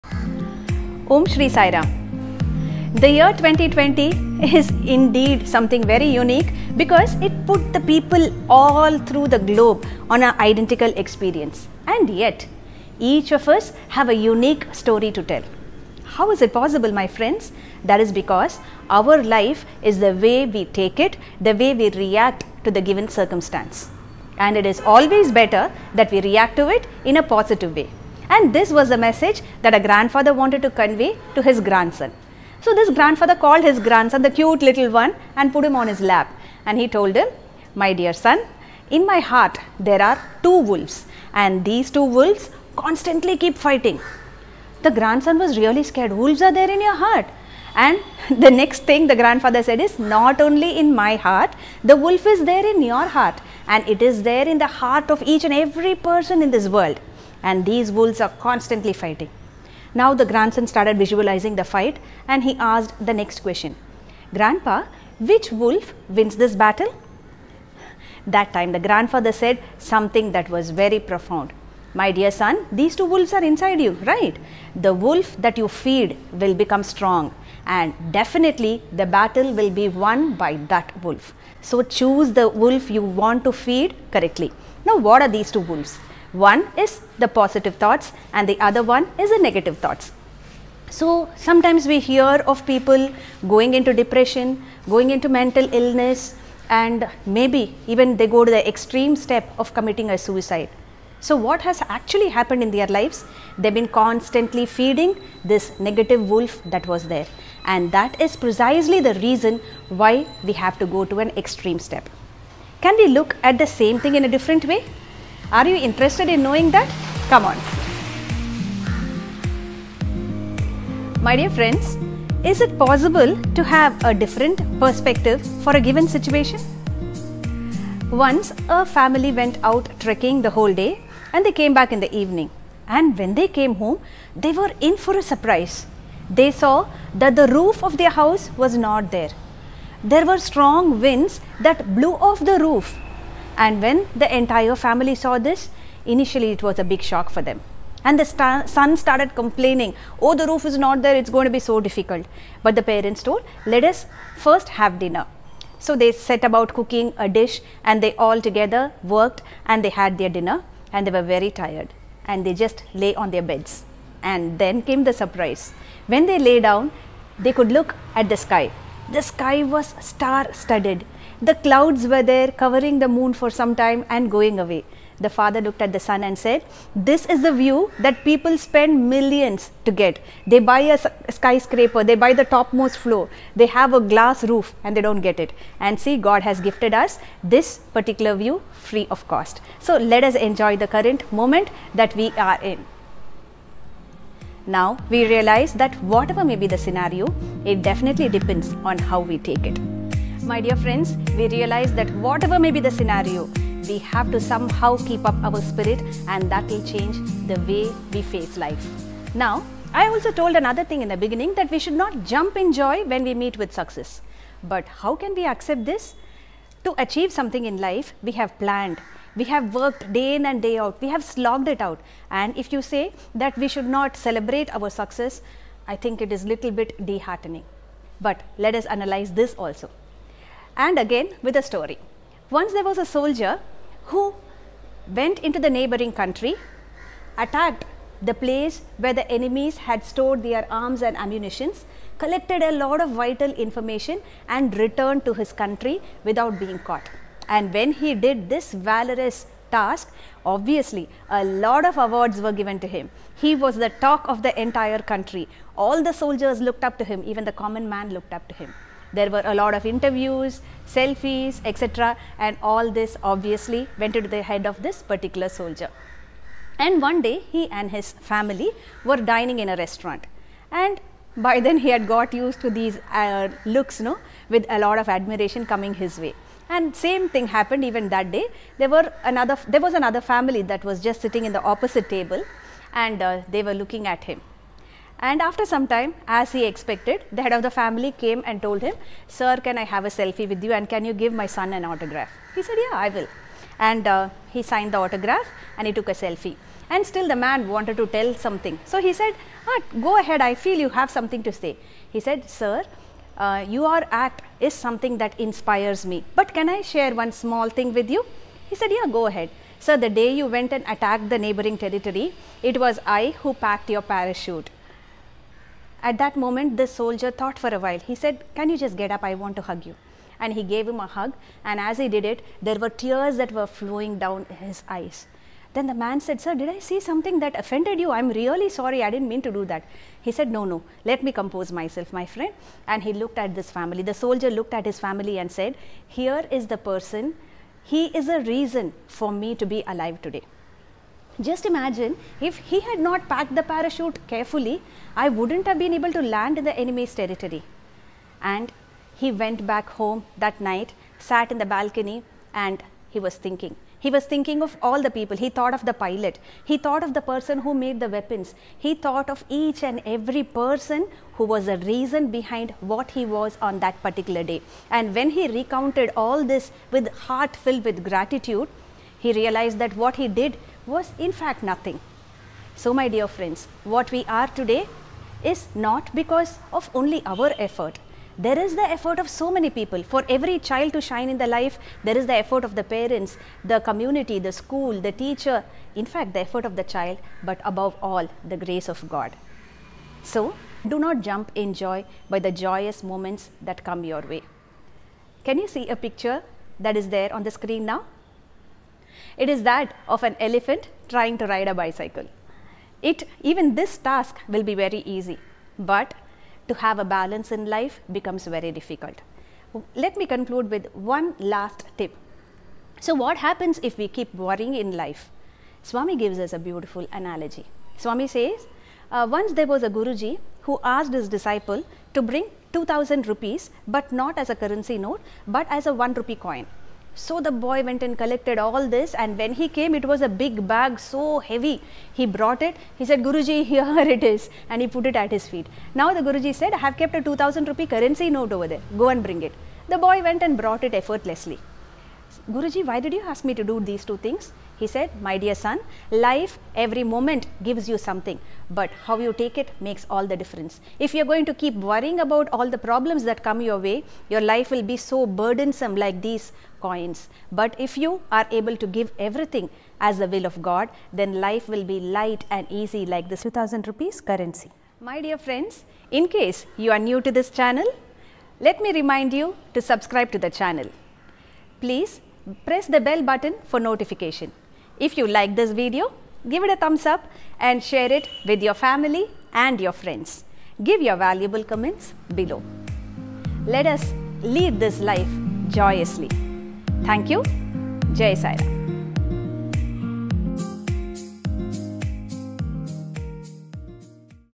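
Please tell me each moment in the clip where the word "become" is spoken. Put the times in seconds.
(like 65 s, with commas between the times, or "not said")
76 s, 408 s.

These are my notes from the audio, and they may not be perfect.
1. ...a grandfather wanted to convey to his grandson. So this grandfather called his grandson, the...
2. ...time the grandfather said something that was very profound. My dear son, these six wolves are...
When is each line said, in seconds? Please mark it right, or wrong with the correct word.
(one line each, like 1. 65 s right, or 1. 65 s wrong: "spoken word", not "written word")
1. 29 s right
2. 68 s wrong: "two", not "six".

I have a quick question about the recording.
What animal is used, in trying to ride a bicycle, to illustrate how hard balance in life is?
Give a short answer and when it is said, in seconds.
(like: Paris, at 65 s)
Elephant, at 400 s.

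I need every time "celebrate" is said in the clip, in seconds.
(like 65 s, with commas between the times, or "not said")
224 s.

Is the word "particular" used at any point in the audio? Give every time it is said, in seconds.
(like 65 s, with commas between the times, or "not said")
187 s, 265 s, 364 s.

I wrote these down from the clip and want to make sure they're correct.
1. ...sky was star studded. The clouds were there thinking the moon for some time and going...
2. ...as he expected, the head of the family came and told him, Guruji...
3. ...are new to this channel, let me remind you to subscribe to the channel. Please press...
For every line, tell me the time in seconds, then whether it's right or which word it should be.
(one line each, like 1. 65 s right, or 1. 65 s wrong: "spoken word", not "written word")
1. 169 s wrong: "covering", not "thinking"
2. 286 s wrong: "Sir", not "Guruji"
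3. 466 s right.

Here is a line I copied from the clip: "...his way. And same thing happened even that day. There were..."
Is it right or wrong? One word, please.
right.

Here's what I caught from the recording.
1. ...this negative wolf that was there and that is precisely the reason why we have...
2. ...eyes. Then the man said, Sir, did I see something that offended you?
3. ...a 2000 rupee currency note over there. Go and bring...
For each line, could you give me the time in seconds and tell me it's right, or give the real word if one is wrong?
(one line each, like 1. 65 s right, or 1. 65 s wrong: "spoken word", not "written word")
1. 105 s right
2. 324 s right
3. 437 s right.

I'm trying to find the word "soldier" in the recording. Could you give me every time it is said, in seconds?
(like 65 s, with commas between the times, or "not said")
233 s, 256 s, 265 s, 316 s, 334 s.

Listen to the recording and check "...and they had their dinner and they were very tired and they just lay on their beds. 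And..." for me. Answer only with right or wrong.
right.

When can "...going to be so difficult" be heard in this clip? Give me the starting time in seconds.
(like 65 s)
151 s.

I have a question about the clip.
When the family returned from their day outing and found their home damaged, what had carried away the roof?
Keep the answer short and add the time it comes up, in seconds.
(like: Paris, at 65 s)
Strong winds, at 140 s.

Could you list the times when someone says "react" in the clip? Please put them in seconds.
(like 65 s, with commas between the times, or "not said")
21 s, 26 s.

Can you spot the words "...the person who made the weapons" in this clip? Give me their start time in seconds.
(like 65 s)
357 s.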